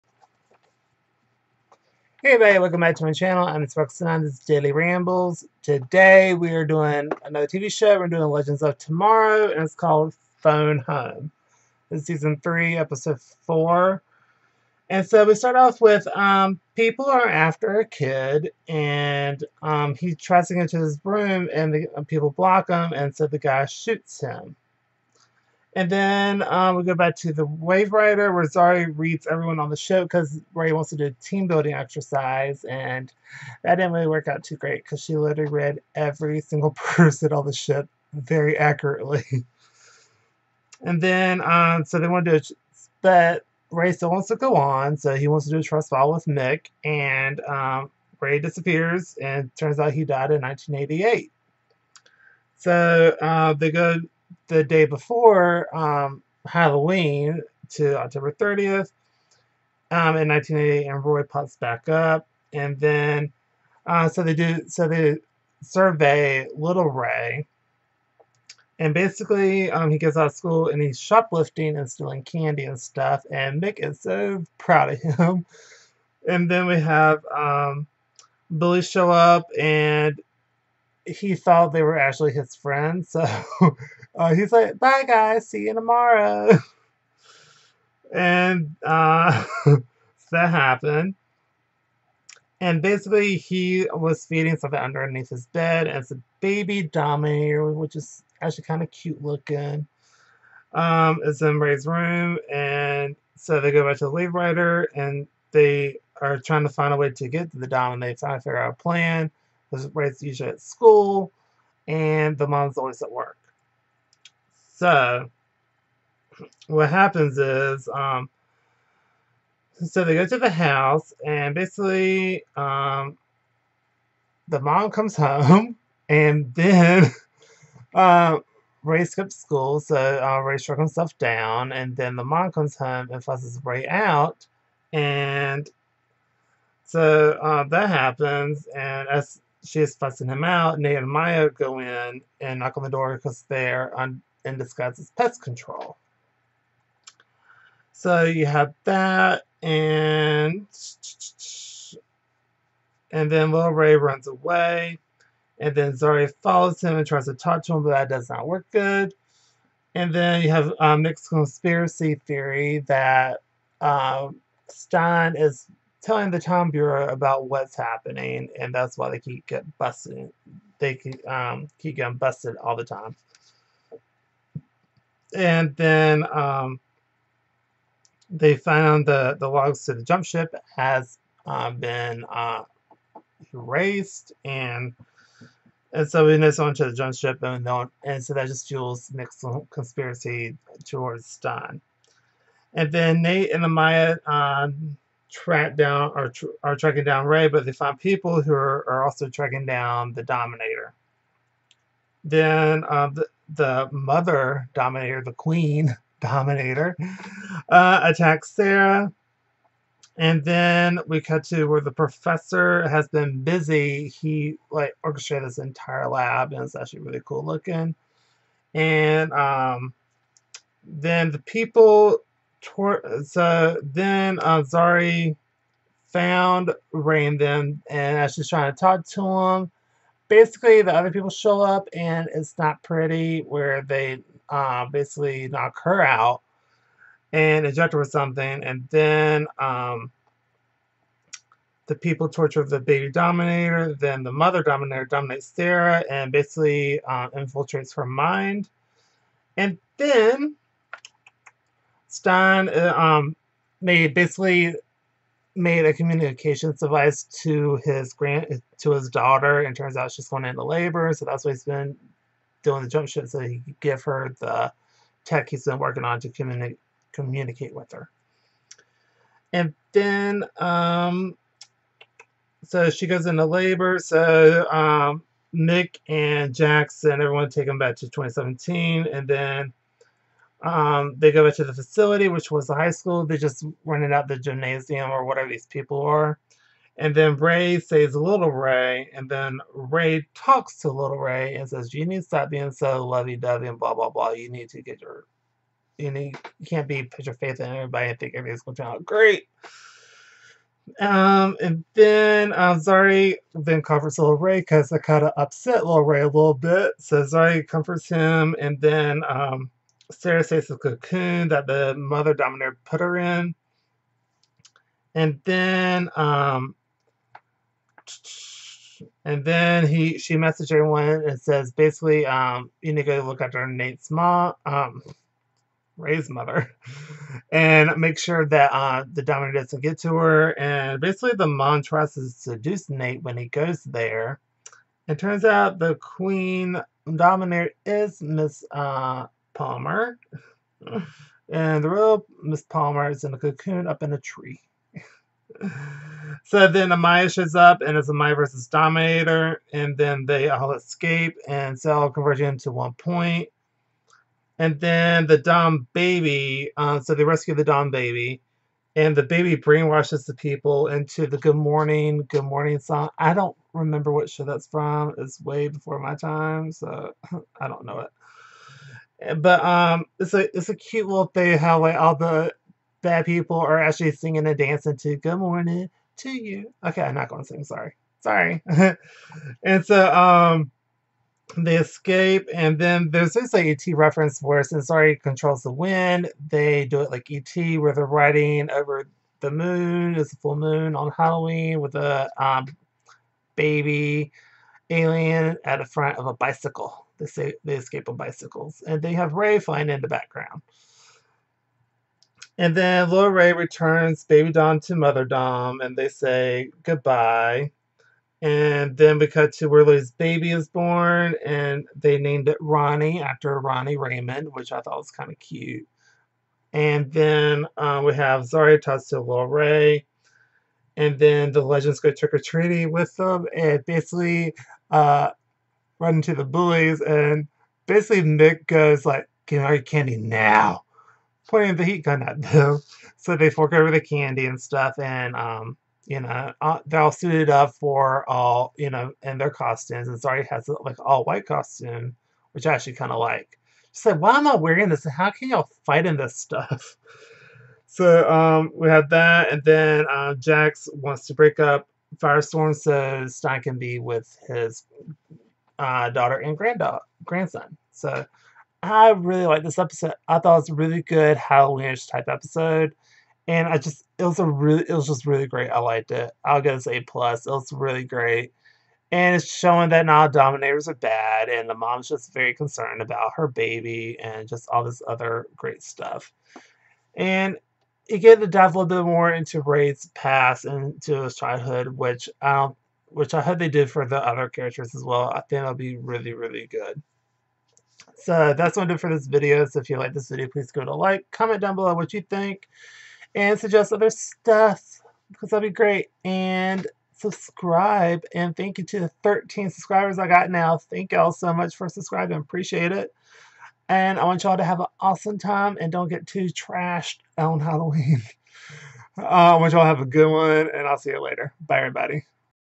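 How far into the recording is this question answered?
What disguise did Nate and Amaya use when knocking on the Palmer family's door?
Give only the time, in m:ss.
2:25.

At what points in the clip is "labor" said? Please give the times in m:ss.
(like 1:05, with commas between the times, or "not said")
4:20, 4:33.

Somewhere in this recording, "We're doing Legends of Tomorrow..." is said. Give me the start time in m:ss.
0:07.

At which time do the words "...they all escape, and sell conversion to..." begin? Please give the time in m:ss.
5:50.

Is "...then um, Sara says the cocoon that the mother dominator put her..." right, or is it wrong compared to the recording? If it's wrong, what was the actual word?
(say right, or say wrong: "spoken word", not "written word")
right.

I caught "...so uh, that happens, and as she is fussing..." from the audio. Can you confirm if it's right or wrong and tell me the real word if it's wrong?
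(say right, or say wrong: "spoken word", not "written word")
right.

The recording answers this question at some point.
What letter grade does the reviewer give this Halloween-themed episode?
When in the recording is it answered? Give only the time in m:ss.
7:46.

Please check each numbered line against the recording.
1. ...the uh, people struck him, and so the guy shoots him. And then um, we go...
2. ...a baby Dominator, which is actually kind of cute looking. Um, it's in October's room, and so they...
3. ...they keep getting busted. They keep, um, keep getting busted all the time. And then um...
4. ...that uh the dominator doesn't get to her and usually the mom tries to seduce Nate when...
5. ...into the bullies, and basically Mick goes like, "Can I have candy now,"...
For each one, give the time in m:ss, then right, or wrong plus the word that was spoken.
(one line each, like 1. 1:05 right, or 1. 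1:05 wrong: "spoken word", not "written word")
1. 0:21 wrong: "block", not "struck"
2. 1:36 wrong: "Ray", not "October"
3. 2:49 right
4. 5:28 wrong: "basically", not "usually"
5. 7:06 right.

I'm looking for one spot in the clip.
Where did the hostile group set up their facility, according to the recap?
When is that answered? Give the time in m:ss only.
4:42.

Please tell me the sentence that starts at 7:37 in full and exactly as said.
So I really like this episode.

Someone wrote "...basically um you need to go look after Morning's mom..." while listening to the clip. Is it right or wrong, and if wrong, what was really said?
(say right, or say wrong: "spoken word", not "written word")
wrong: "Nate", not "Morning".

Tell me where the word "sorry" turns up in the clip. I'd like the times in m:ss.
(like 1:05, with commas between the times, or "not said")
6:17, 6:24.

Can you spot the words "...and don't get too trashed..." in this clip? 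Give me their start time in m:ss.
8:25.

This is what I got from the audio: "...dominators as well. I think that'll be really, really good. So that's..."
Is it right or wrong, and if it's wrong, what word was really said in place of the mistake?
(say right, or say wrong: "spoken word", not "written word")
wrong: "characters", not "dominators".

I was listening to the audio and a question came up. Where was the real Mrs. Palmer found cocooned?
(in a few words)
Up in a tree.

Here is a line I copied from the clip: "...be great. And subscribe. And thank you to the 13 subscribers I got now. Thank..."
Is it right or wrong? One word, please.
right.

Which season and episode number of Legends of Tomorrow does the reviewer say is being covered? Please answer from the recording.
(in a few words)
Season 3, episode 4.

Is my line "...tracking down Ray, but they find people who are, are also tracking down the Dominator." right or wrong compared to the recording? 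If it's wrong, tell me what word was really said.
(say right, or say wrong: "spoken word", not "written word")
right.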